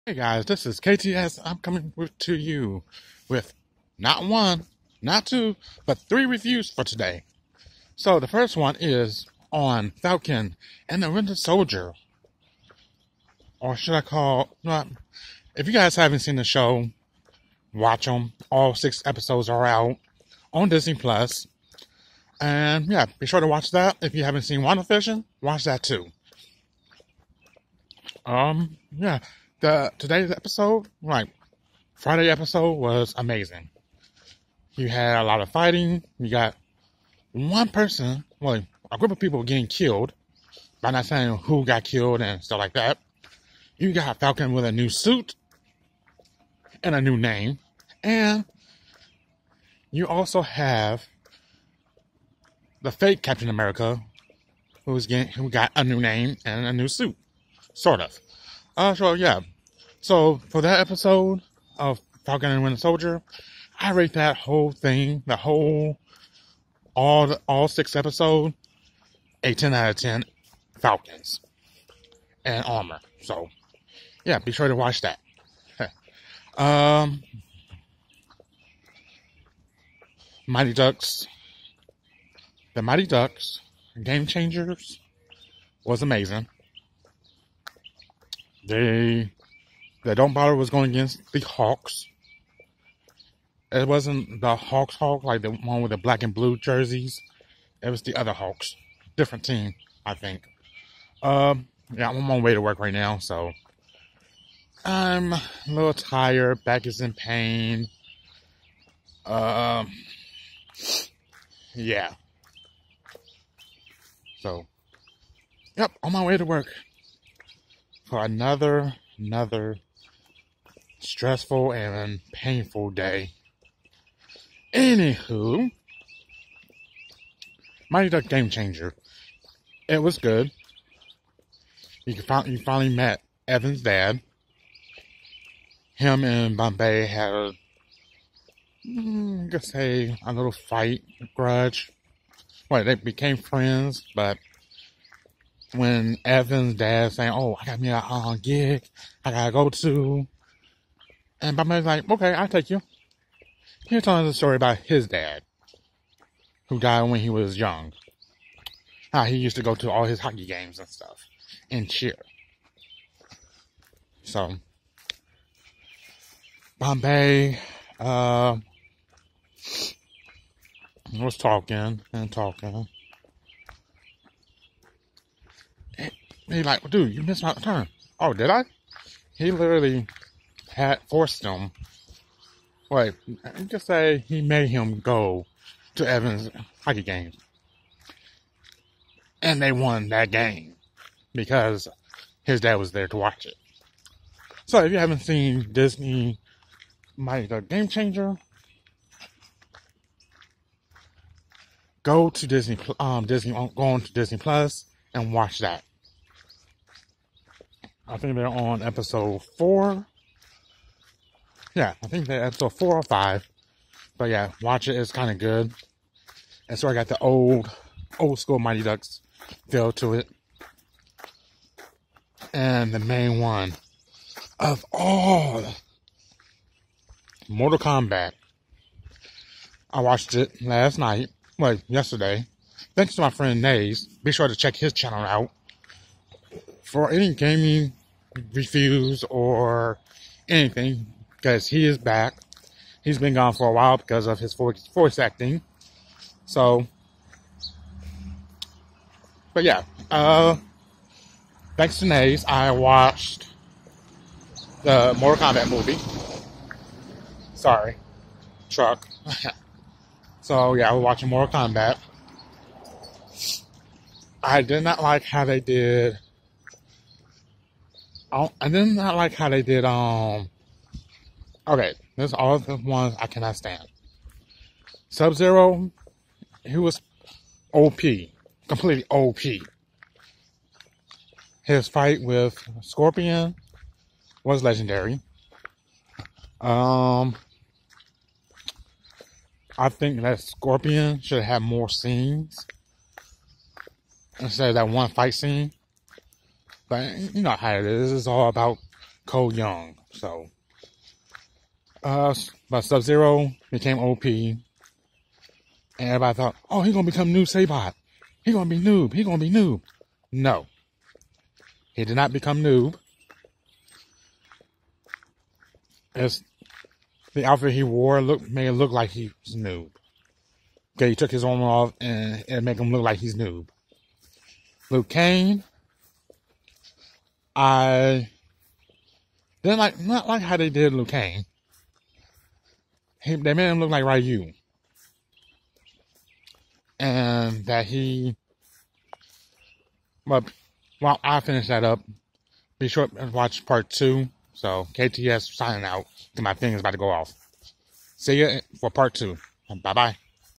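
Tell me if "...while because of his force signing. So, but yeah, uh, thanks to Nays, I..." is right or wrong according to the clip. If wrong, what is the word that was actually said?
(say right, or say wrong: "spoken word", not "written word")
wrong: "acting", not "signing".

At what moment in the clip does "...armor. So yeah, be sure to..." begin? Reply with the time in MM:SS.
01:12.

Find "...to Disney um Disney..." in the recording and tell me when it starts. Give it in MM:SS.
03:22.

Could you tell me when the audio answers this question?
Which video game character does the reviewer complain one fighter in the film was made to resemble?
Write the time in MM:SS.
05:34.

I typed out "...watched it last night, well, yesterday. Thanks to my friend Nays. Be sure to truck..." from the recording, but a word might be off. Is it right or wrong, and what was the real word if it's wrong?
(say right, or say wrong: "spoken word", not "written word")
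wrong: "check", not "truck".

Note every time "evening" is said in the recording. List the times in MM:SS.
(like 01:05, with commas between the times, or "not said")
not said.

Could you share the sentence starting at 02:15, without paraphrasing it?
Him and Bombay had a, mm, I guess, a, a little fight, a grudge.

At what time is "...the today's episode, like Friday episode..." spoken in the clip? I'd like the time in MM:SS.
00:29.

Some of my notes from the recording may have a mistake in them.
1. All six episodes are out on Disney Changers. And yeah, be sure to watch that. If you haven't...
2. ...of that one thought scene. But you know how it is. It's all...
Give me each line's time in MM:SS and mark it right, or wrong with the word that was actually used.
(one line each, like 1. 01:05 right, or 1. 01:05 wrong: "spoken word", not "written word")
1. 00:18 wrong: "Plus", not "Changers"
2. 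04:54 wrong: "fight", not "thought".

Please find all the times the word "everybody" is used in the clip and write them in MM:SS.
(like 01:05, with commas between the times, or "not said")
05:05.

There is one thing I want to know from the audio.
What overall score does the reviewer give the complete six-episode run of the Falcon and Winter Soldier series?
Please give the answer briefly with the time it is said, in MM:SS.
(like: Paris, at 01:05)
10 out of 10, at 01:09.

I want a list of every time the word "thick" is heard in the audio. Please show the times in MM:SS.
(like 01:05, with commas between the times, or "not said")
not said.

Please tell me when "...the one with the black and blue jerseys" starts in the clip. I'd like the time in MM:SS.
01:35.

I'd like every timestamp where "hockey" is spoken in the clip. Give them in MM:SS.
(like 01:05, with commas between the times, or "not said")
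02:40, 03:06.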